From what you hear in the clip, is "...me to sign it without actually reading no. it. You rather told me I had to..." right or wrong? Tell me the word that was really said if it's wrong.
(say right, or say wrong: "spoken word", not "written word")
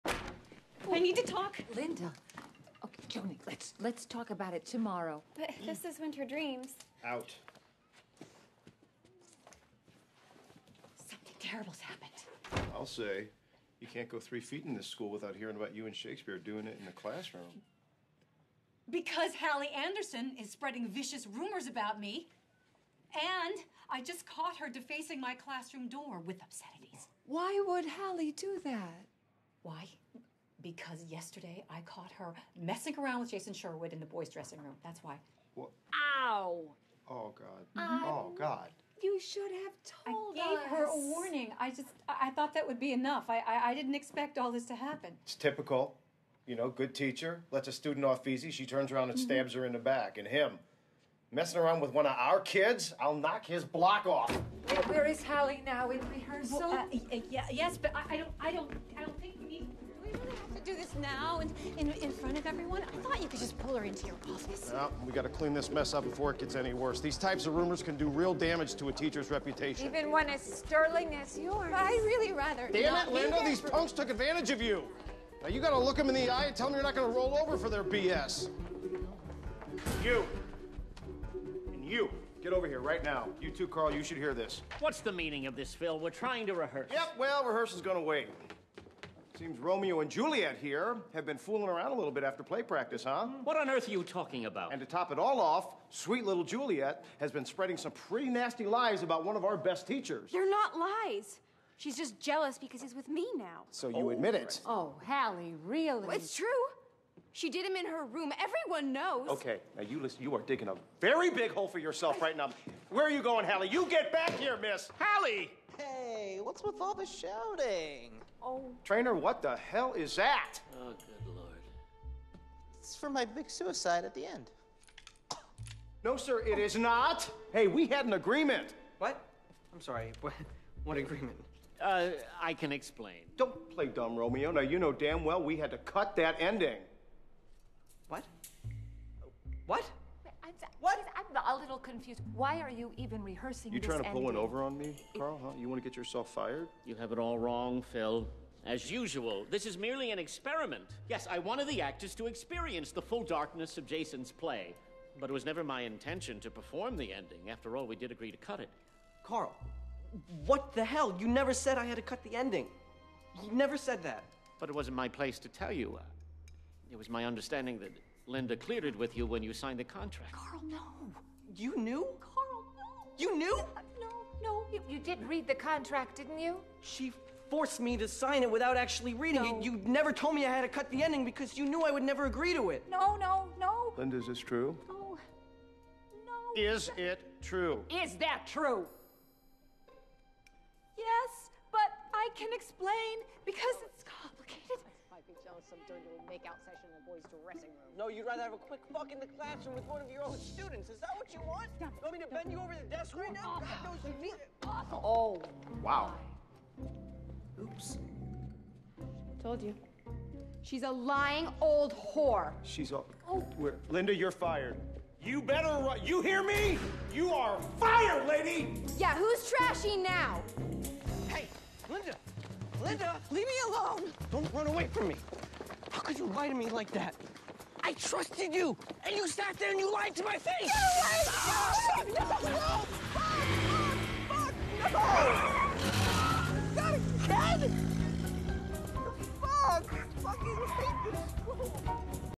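wrong: "never", not "rather".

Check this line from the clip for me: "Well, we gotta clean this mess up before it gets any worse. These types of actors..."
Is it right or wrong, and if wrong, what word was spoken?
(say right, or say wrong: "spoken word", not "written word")
wrong: "rumors", not "actors".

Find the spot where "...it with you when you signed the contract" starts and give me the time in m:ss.
2:48.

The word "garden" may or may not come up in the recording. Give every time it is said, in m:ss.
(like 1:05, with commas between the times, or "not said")
not said.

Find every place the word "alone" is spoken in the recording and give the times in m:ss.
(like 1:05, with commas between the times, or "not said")
3:43.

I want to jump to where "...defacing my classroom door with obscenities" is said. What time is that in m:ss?
0:24.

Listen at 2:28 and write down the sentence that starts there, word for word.
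As usual, this is merely an experiment.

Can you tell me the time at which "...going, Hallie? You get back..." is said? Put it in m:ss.
1:53.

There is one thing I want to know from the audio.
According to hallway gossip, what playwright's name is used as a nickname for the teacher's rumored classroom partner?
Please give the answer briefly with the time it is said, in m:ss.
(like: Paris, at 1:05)
Shakespeare, at 0:15.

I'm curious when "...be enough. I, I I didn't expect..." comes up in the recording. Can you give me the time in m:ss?
0:42.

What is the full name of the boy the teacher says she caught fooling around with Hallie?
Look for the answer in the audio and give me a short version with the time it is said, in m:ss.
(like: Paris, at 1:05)
Jason Sherwood, at 0:33.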